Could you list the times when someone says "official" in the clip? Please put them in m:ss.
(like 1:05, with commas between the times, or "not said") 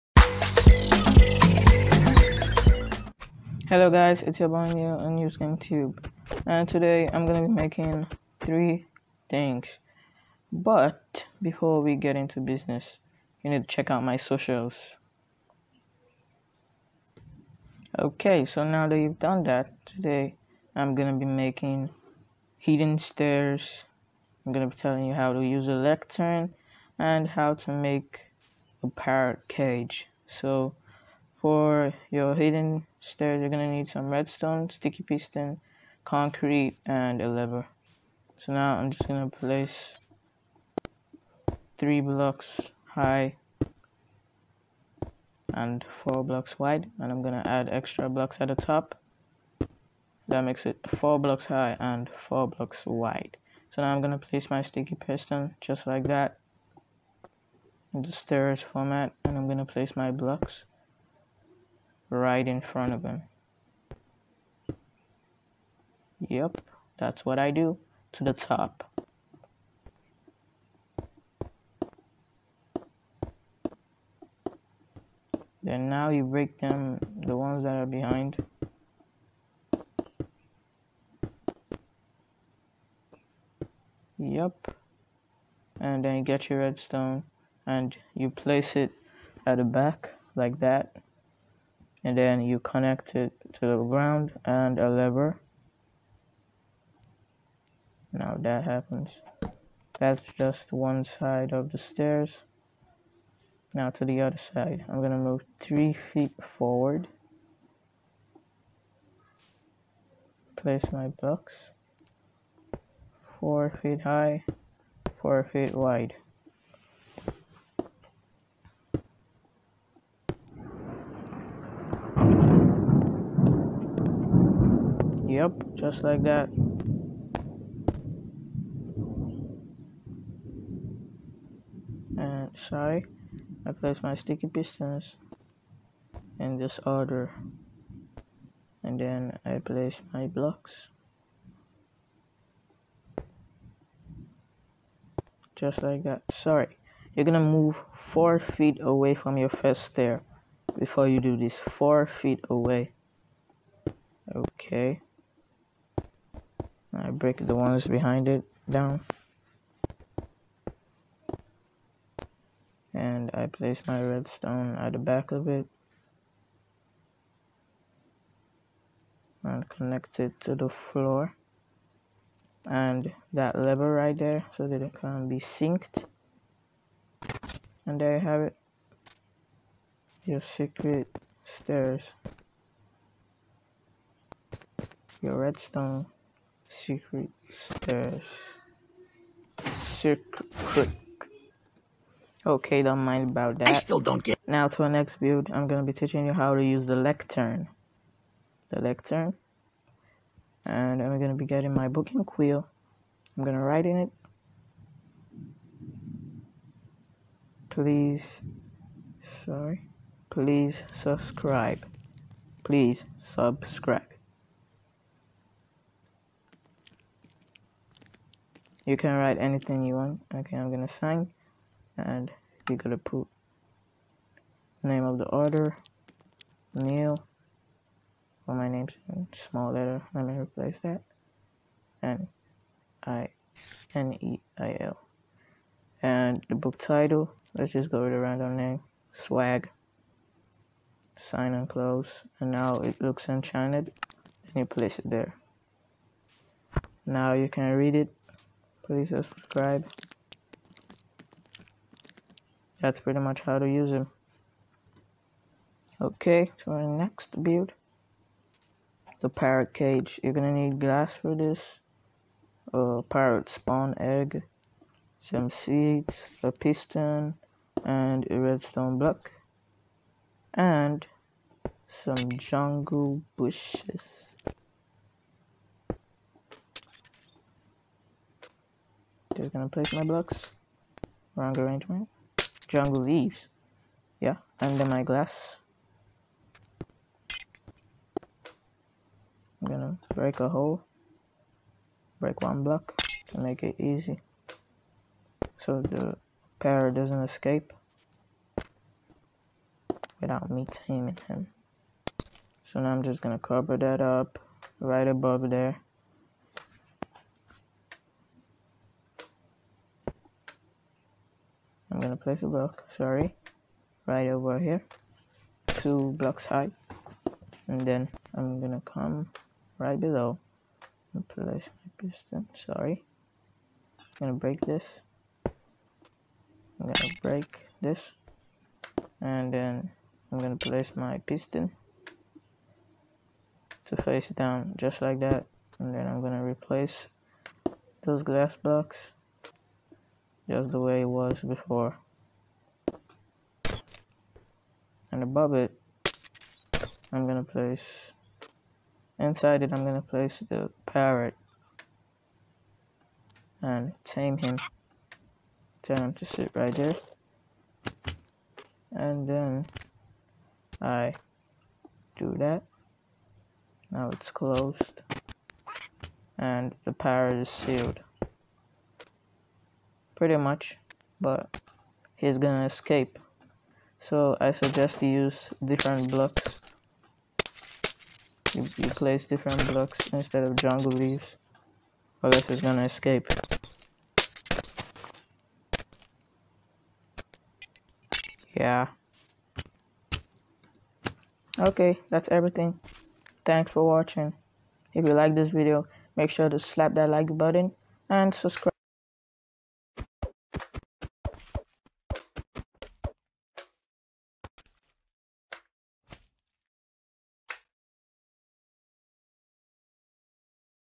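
not said.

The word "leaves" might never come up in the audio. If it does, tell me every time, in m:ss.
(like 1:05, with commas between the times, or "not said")
4:43, 6:20.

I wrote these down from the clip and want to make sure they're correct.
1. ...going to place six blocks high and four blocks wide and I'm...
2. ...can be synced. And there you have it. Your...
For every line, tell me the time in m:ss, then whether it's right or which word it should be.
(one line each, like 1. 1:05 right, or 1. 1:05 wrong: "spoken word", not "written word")
1. 0:39 wrong: "three", not "six"
2. 2:54 right.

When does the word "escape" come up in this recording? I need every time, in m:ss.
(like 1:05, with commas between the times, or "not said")
4:57, 6:12, 6:22.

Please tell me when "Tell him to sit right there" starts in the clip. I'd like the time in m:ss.
5:55.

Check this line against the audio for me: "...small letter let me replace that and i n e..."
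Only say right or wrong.
right.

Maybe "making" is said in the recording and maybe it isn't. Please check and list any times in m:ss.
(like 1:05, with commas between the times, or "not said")
0:07, 0:21.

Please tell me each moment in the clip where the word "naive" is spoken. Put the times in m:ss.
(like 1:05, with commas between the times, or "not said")
not said.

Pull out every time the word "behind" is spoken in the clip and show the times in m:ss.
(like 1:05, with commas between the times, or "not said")
1:17, 2:37.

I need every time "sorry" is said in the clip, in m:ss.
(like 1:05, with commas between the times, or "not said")
2:12, 2:26, 3:29, 5:12, 5:22.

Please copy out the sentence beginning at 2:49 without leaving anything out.
And connect it to the floor.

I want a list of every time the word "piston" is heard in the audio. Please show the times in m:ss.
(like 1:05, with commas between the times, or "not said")
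0:35, 0:54, 2:14, 4:26, 5:22, 5:31.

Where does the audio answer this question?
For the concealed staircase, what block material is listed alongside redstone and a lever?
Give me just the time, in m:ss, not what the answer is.
0:36.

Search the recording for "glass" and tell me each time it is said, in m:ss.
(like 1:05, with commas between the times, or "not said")
4:20, 4:45, 5:38.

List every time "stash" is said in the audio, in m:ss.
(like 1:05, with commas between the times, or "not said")
3:07.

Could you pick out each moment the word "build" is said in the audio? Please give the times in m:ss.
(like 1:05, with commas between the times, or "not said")
3:15, 4:17.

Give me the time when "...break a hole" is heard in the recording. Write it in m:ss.
4:50.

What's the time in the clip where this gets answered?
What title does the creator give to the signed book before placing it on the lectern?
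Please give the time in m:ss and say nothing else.
3:59.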